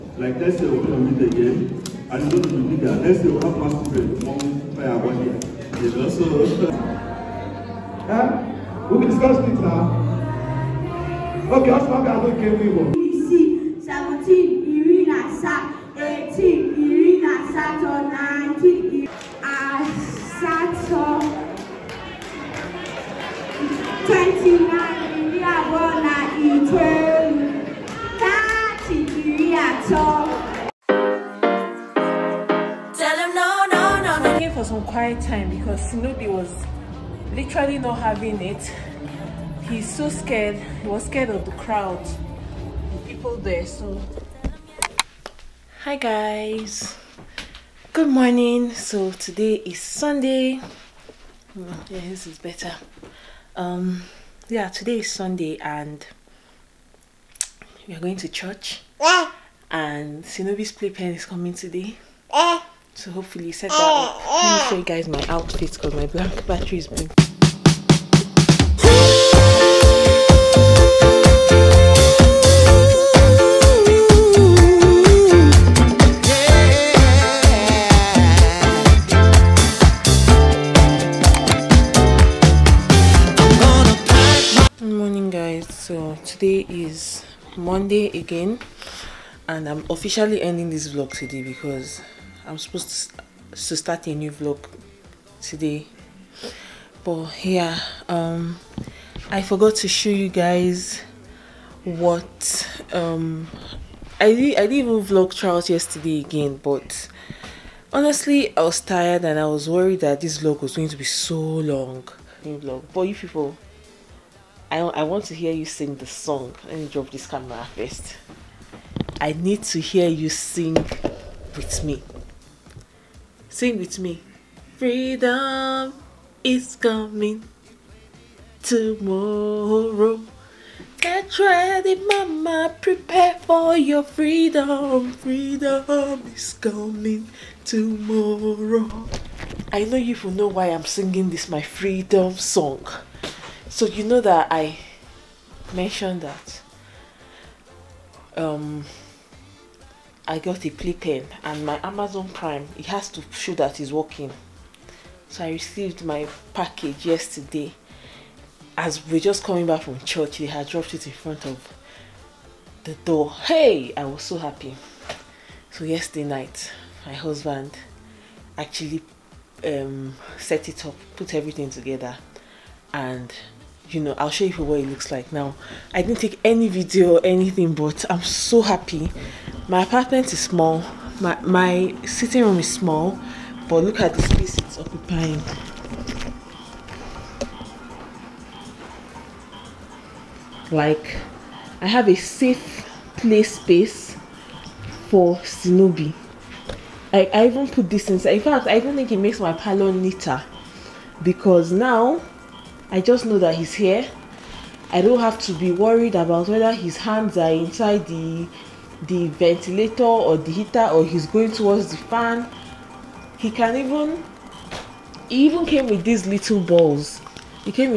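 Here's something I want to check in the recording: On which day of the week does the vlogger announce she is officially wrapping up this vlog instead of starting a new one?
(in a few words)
Monday.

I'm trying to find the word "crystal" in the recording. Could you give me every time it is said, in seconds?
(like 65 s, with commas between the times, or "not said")
not said.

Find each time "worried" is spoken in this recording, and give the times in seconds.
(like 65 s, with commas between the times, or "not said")
109 s, 205 s.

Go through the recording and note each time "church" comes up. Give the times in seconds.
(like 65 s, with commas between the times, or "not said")
58 s, 159 s.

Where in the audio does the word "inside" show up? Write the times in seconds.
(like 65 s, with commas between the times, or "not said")
198 s, 207 s.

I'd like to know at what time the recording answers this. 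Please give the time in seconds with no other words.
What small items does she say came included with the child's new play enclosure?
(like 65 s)
216 s.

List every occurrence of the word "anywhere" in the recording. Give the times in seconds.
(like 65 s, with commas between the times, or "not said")
not said.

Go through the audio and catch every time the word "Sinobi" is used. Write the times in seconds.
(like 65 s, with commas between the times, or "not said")
60 s, 195 s.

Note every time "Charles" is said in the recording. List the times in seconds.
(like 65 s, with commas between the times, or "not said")
105 s.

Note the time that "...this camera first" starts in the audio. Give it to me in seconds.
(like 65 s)
117 s.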